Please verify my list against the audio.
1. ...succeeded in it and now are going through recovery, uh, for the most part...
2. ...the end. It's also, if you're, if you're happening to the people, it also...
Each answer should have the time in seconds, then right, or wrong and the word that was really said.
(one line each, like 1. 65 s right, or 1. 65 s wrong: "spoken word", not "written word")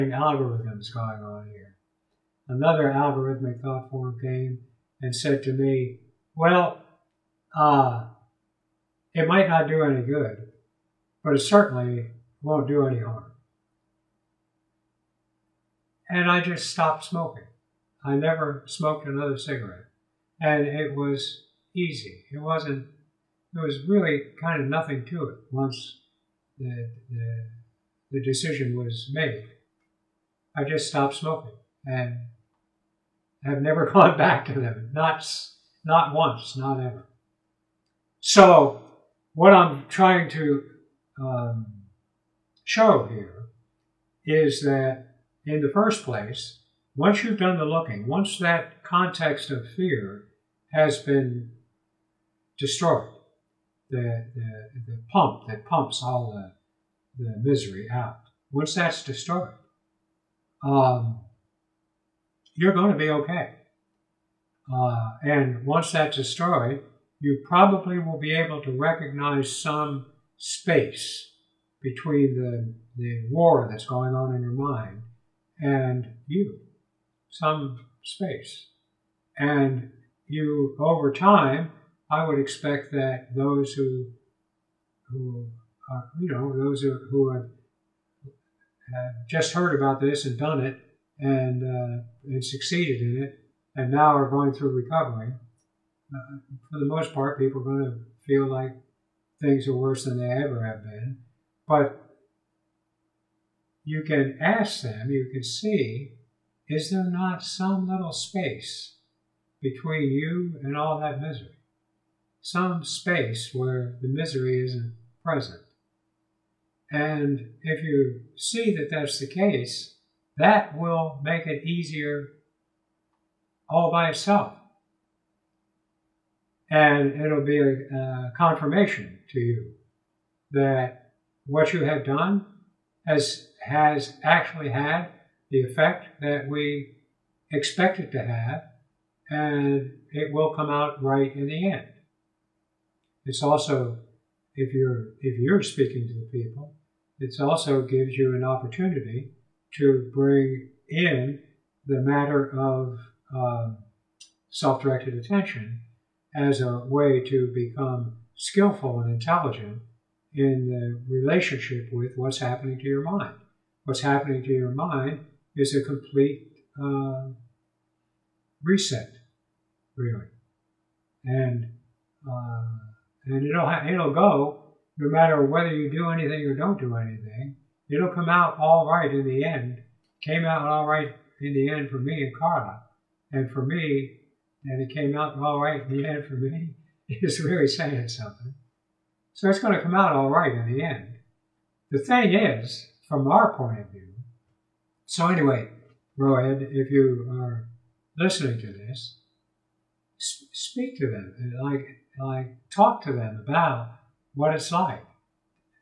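1. 92 s right
2. 141 s wrong: "speaking", not "happening".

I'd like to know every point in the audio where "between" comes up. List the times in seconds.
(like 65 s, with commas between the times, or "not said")
71 s, 109 s.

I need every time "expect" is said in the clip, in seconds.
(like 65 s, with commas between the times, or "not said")
82 s, 137 s.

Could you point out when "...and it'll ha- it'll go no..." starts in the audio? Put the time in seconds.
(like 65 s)
173 s.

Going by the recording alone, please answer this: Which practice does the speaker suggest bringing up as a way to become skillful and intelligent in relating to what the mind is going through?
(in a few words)
self directed attention.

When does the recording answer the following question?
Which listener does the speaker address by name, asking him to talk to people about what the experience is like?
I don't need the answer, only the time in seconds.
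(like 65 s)
196 s.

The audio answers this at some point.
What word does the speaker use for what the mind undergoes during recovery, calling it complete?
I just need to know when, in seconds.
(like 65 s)
168 s.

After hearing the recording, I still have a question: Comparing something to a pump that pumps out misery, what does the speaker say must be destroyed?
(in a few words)
context of fear.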